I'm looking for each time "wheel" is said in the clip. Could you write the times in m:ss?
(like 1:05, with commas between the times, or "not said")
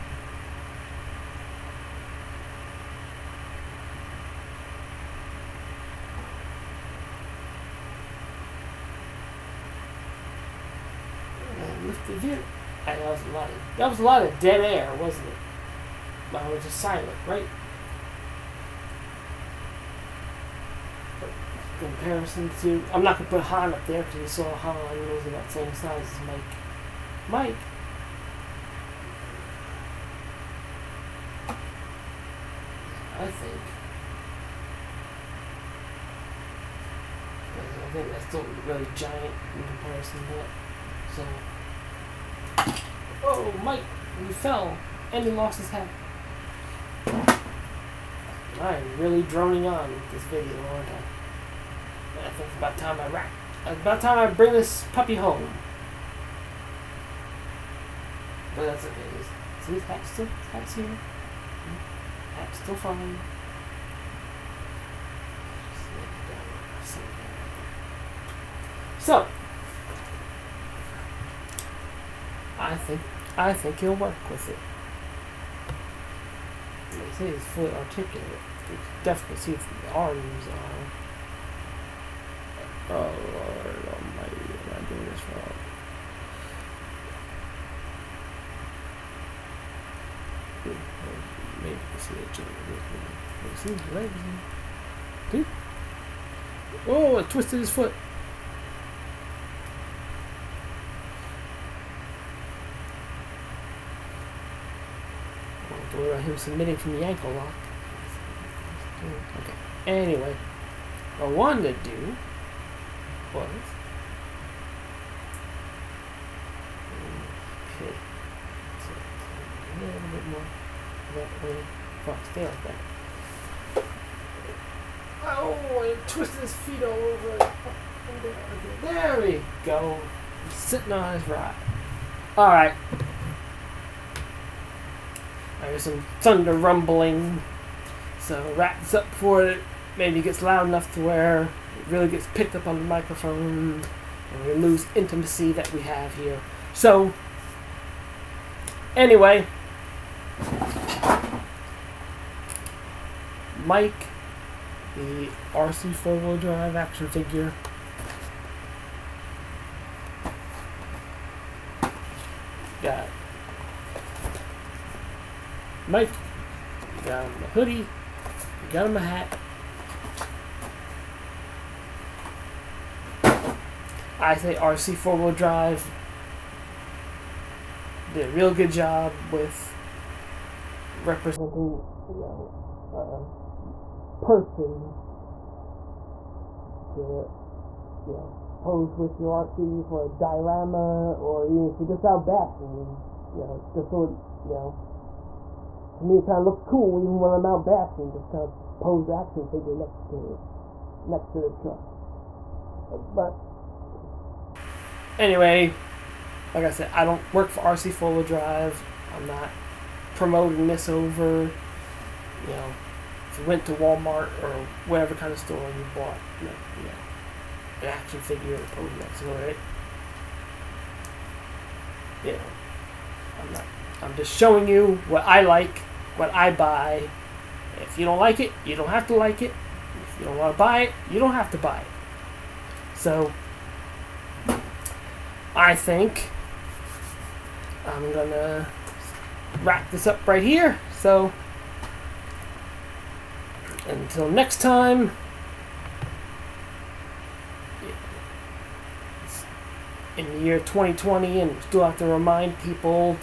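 2:36, 2:55, 3:28.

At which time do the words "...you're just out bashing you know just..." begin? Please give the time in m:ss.
3:11.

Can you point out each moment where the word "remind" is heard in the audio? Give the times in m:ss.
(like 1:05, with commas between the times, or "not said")
4:12.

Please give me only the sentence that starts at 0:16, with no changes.
Well, it was just silent, right?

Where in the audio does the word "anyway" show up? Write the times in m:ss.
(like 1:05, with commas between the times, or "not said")
1:50, 2:28, 3:25.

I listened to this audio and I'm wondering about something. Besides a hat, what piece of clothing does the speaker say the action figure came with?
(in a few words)
Hoodie.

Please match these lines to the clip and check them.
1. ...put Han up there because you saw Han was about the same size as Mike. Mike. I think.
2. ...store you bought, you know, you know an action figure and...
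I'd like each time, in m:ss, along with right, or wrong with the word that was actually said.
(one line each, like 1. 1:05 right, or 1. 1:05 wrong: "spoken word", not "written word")
1. 0:23 right
2. 3:35 right.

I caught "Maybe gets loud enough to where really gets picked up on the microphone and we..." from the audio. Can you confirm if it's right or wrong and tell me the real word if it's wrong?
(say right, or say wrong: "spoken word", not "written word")
right.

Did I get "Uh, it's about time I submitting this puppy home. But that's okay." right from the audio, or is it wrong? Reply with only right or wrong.
wrong.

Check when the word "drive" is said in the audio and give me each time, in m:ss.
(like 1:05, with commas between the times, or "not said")
2:36, 2:55, 3:28.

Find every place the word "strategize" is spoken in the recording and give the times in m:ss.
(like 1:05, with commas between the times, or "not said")
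not said.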